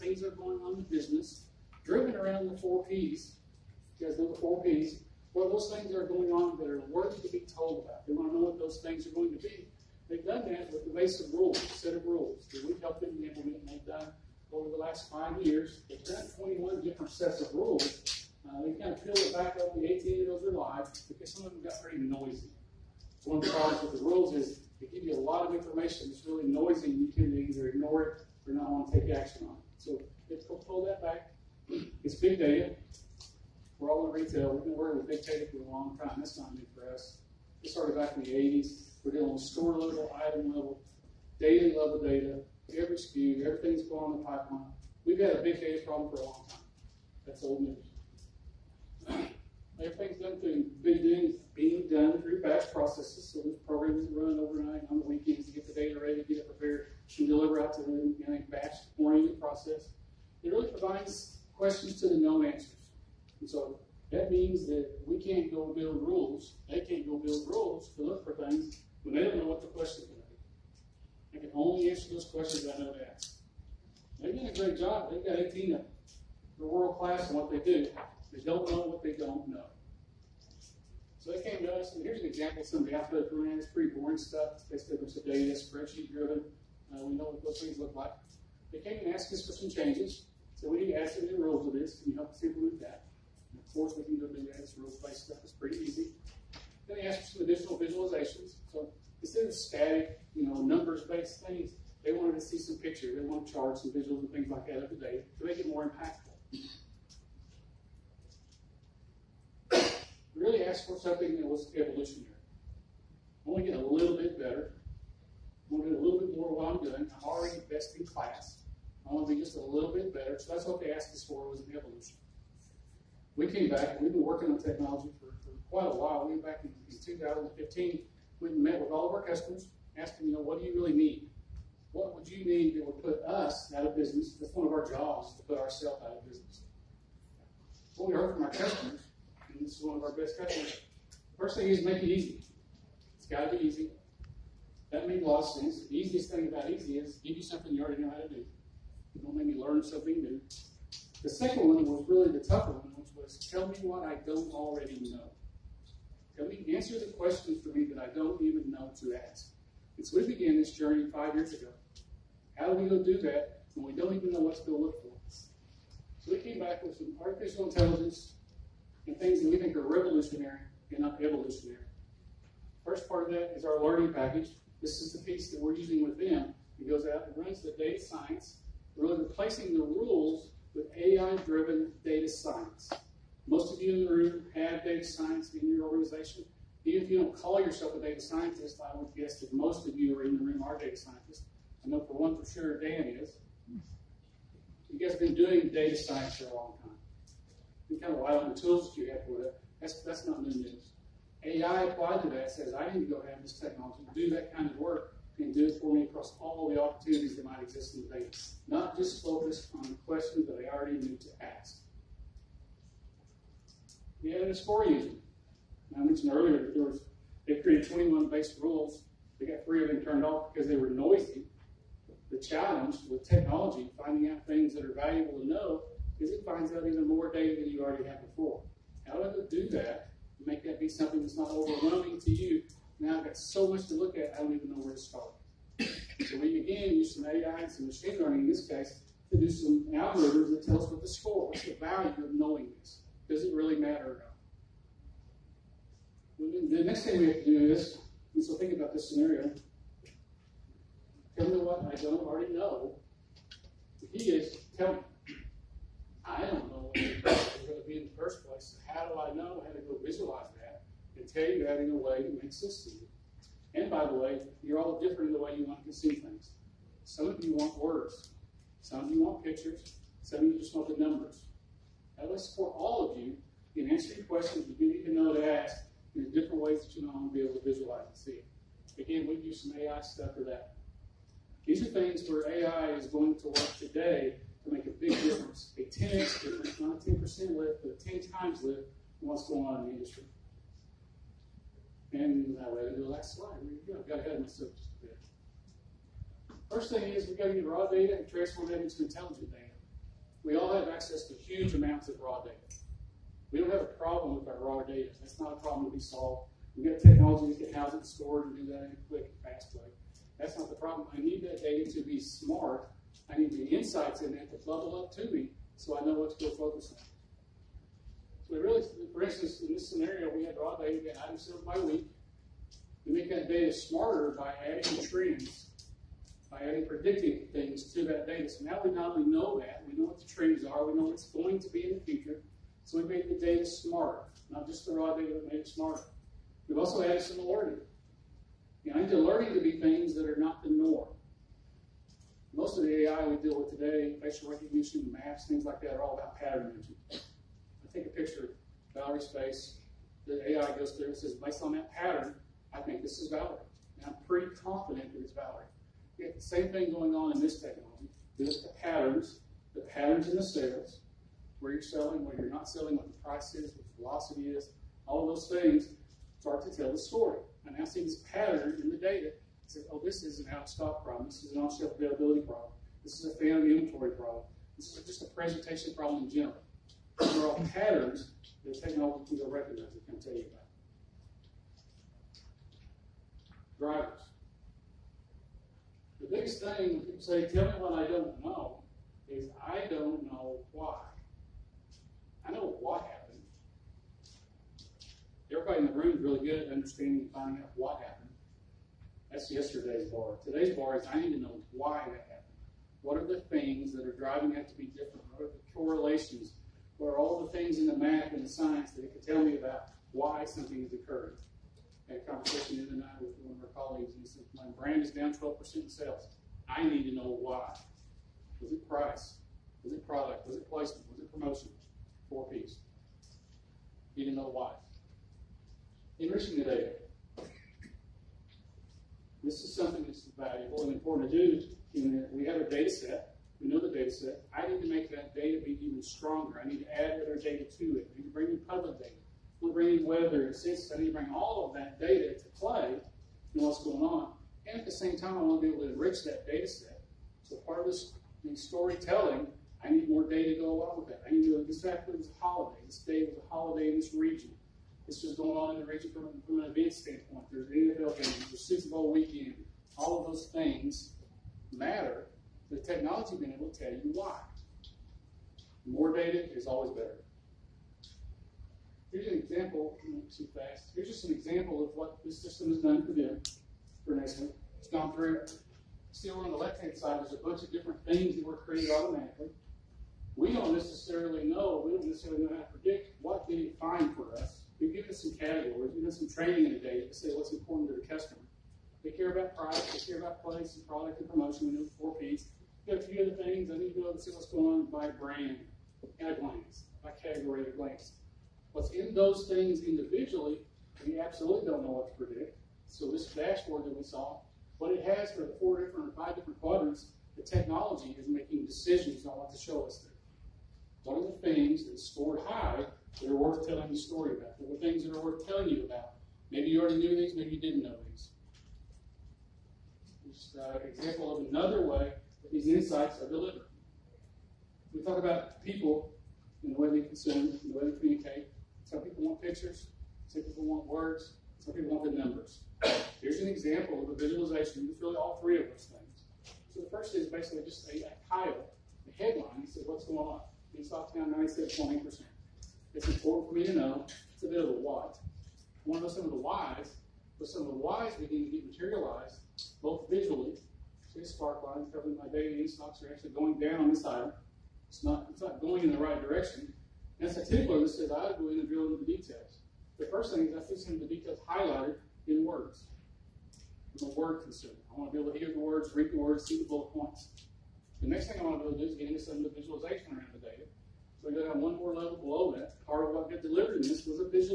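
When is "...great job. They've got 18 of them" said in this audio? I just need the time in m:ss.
1:14.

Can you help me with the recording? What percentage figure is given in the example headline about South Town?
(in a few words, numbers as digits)
97.8%.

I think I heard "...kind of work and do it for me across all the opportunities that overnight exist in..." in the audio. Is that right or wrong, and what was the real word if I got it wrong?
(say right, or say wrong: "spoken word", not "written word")
wrong: "might", not "overnight".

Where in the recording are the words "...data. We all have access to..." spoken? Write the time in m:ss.
4:59.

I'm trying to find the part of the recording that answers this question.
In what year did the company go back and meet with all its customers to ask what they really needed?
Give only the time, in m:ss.
2:07.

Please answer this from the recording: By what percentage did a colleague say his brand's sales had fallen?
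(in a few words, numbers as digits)
12%.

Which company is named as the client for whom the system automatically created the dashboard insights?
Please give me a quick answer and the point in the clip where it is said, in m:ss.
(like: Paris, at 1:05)
Nestle, at 7:54.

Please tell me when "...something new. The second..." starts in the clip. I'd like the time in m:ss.
2:29.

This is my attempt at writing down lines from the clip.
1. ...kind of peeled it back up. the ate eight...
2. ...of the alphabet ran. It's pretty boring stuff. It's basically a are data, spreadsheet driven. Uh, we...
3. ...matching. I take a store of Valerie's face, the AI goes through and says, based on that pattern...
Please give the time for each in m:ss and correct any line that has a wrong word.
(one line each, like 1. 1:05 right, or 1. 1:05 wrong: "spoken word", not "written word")
1. 0:18 right
2. 1:22 right
3. 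5:46 wrong: "picture", not "store".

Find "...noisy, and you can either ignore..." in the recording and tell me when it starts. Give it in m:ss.
0:26.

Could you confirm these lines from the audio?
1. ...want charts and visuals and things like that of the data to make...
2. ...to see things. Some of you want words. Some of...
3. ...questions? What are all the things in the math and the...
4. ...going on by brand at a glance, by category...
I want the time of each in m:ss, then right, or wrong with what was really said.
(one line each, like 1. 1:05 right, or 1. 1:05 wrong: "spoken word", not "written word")
1. 1:43 right
2. 4:25 right
3. 6:45 wrong: "correlations", not "questions"
4. 8:14 right.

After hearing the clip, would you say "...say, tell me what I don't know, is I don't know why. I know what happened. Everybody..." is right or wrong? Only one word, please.
right.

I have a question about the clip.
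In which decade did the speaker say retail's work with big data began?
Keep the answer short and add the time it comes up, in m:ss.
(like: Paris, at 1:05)
the 80s, at 0:38.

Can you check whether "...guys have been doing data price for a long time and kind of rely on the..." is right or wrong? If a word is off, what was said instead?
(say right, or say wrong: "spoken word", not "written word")
wrong: "science", not "price".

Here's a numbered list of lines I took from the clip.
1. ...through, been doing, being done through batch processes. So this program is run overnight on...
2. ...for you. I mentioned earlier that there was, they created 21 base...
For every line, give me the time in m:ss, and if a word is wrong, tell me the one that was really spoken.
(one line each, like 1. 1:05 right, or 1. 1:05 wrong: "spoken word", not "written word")
1. 0:50 right
2. 3:34 right.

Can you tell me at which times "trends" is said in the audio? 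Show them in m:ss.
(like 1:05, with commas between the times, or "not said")
5:25, 5:30.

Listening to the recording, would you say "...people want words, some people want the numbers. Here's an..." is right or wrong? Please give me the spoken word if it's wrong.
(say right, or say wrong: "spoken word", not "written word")
right.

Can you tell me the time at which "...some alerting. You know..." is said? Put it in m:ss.
5:37.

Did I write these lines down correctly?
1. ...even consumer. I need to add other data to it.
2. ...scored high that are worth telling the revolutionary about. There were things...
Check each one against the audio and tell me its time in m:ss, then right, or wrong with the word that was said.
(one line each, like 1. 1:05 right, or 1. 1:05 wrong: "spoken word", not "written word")
1. 7:15 wrong: "stronger", not "consumer"
2. 8:31 wrong: "story", not "revolutionary".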